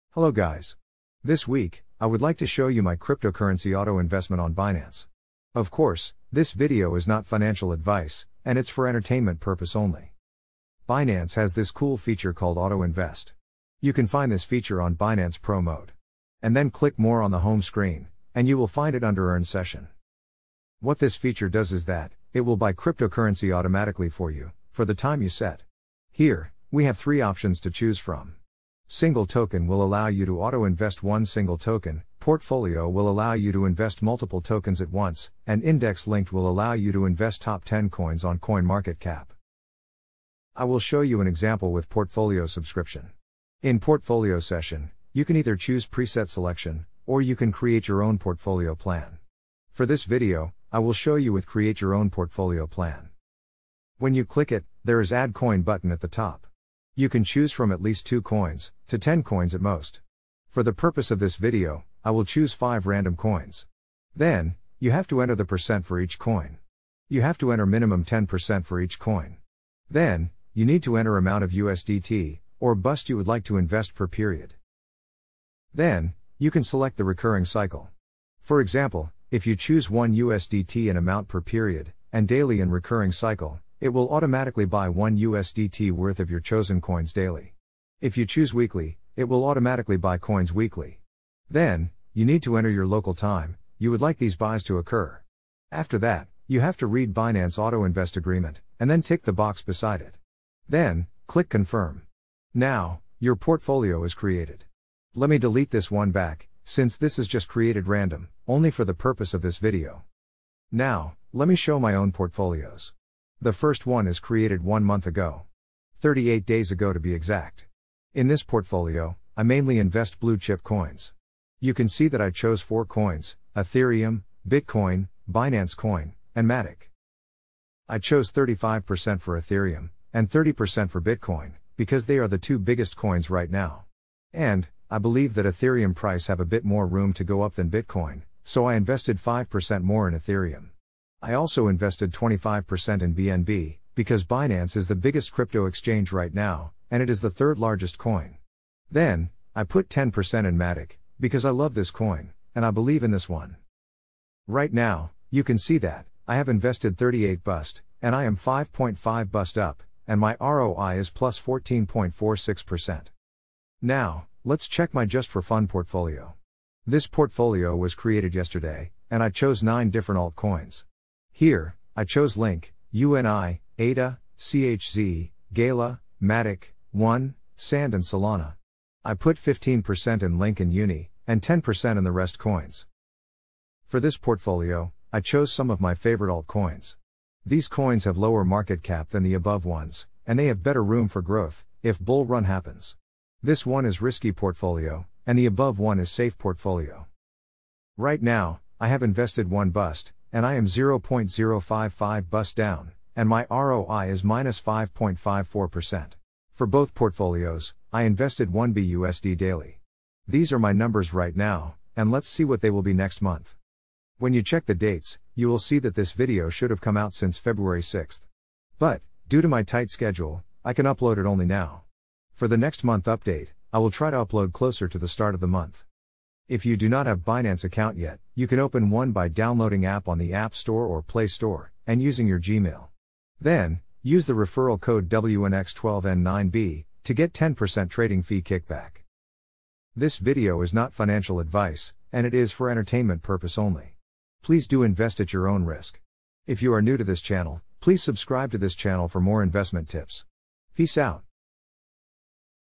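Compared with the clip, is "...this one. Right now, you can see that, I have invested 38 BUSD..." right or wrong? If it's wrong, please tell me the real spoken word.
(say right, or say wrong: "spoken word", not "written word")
right.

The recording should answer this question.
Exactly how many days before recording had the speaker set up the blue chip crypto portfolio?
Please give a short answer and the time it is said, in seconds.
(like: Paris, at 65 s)
38 days, at 115 s.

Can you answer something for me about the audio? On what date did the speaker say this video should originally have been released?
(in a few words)
February 6th.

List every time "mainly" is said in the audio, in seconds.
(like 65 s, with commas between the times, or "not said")
119 s.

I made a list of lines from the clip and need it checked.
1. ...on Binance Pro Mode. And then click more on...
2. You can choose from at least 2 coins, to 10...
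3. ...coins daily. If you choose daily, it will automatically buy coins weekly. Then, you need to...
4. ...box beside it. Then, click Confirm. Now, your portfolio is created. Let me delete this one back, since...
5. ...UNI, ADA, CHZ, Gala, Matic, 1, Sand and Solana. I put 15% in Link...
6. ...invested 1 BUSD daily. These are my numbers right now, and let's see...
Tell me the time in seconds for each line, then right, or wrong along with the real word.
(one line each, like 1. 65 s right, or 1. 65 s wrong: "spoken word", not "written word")
1. 14 s right
2. 56 s right
3. 86 s wrong: "weekly", not "daily"
4. 99 s right
5. 172 s right
6. 208 s right.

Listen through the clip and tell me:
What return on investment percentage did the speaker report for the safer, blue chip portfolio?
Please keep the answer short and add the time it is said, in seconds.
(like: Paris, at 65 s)
14.46%, at 161 s.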